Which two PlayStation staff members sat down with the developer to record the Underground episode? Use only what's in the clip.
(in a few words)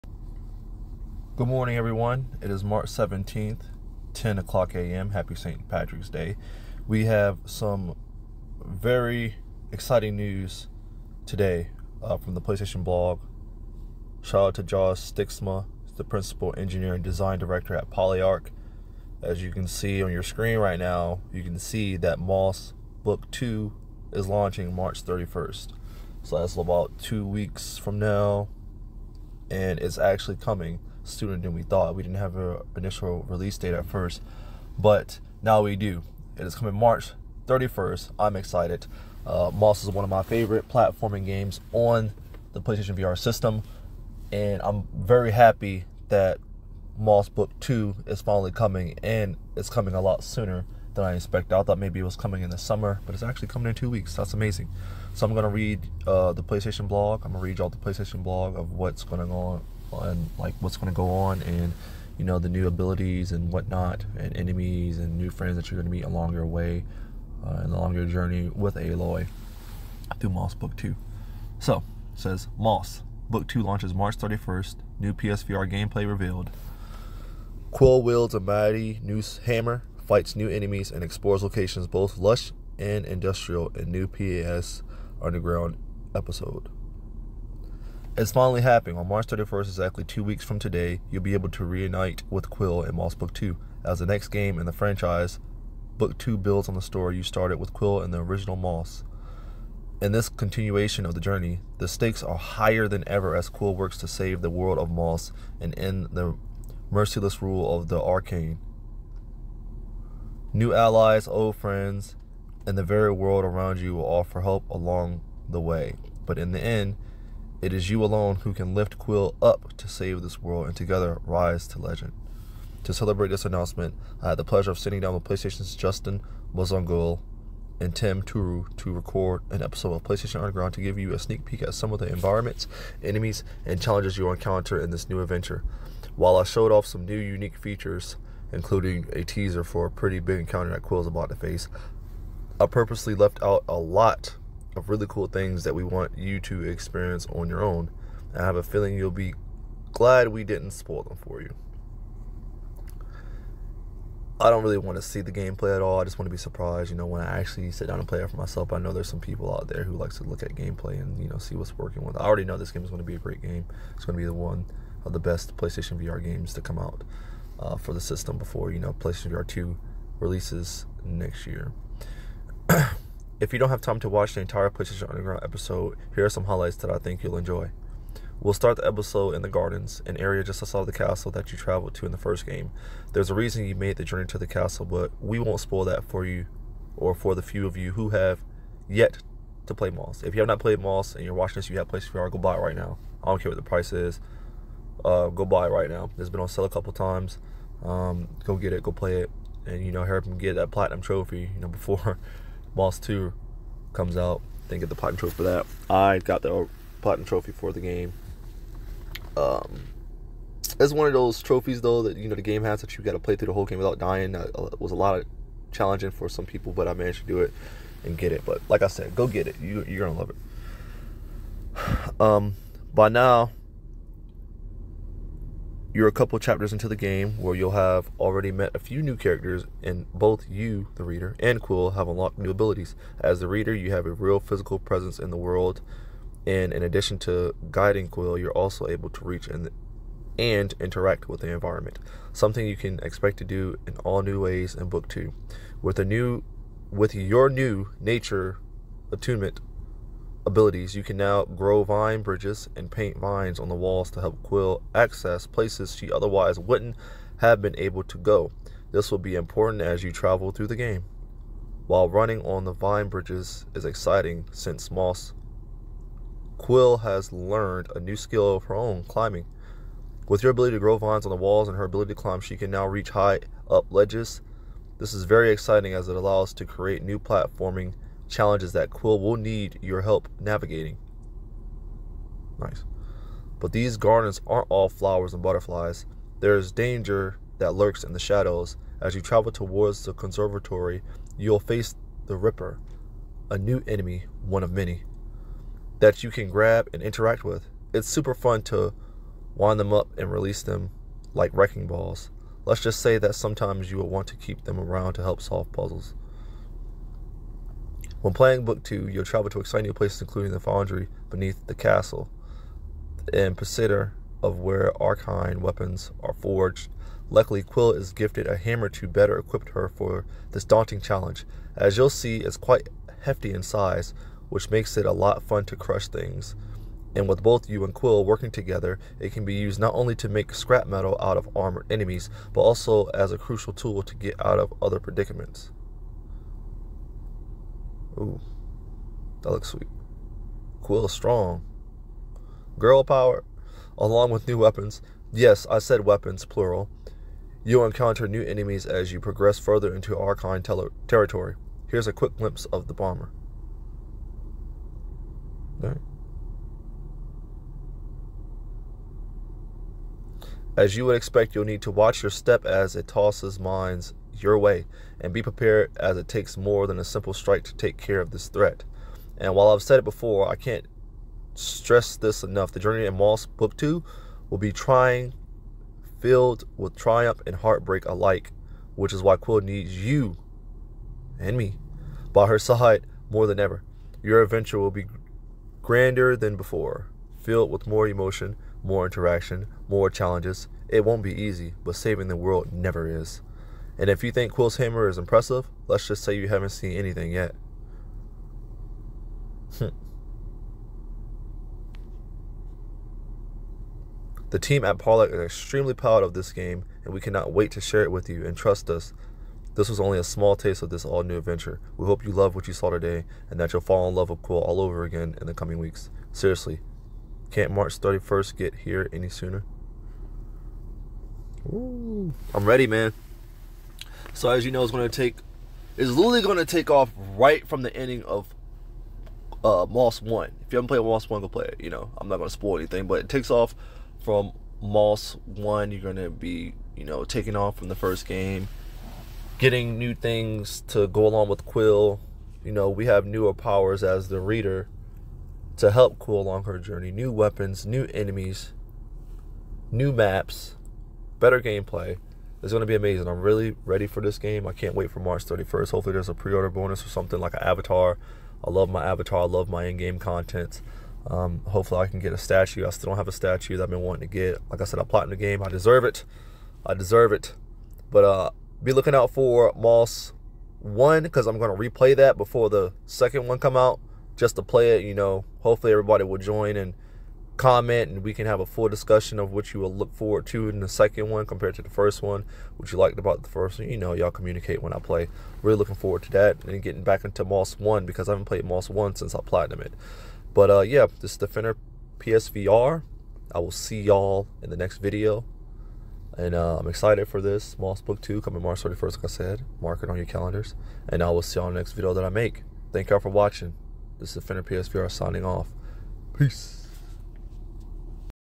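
Justin Massongill and Tim Turi.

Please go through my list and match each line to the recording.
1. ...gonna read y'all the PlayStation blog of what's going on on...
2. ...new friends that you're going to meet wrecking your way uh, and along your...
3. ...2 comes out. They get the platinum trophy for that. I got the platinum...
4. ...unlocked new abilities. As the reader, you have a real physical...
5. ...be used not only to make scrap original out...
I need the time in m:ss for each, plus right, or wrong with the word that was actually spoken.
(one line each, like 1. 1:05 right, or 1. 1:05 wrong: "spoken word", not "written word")
1. 0:57 right
2. 1:05 wrong: "along", not "wrecking"
3. 3:22 right
4. 3:52 right
5. 5:29 wrong: "metal", not "original".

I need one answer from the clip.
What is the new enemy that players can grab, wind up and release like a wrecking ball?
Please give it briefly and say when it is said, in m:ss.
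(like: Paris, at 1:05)
the Ripper, at 4:52.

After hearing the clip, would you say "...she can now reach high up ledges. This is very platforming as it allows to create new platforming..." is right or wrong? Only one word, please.
wrong.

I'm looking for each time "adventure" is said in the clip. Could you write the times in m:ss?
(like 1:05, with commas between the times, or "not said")
2:15, 6:24, 6:51.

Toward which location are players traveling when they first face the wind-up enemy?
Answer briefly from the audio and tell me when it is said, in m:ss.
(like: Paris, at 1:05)
the conservatory, at 4:50.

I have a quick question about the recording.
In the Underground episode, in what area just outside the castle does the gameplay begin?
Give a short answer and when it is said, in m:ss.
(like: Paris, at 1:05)
the gardens, at 2:59.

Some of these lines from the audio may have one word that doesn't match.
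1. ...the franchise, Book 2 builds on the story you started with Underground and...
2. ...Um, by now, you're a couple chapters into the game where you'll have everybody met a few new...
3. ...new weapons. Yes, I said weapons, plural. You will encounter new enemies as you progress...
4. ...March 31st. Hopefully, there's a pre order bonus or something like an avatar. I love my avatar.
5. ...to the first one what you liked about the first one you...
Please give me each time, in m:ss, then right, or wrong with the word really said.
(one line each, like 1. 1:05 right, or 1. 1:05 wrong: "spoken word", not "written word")
1. 1:34 wrong: "Quill", not "Underground"
2. 3:42 wrong: "already", not "everybody"
3. 5:44 right
4. 7:35 right
5. 8:01 right.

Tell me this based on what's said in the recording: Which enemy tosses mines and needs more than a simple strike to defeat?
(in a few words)
the bomber.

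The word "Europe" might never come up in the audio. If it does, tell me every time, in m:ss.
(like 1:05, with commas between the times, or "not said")
not said.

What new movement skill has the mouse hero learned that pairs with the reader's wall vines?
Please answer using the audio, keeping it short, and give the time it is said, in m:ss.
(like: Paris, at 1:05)
climbing, at 4:29.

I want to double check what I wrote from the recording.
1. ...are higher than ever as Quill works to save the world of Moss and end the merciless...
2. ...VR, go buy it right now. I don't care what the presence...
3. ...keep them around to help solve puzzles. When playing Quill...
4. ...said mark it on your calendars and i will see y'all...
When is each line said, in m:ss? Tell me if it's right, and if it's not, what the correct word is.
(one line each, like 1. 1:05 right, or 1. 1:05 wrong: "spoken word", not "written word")
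1. 1:42 right
2. 3:12 wrong: "price", not "presence"
3. 5:04 wrong: "Book", not "Quill"
4. 8:19 right.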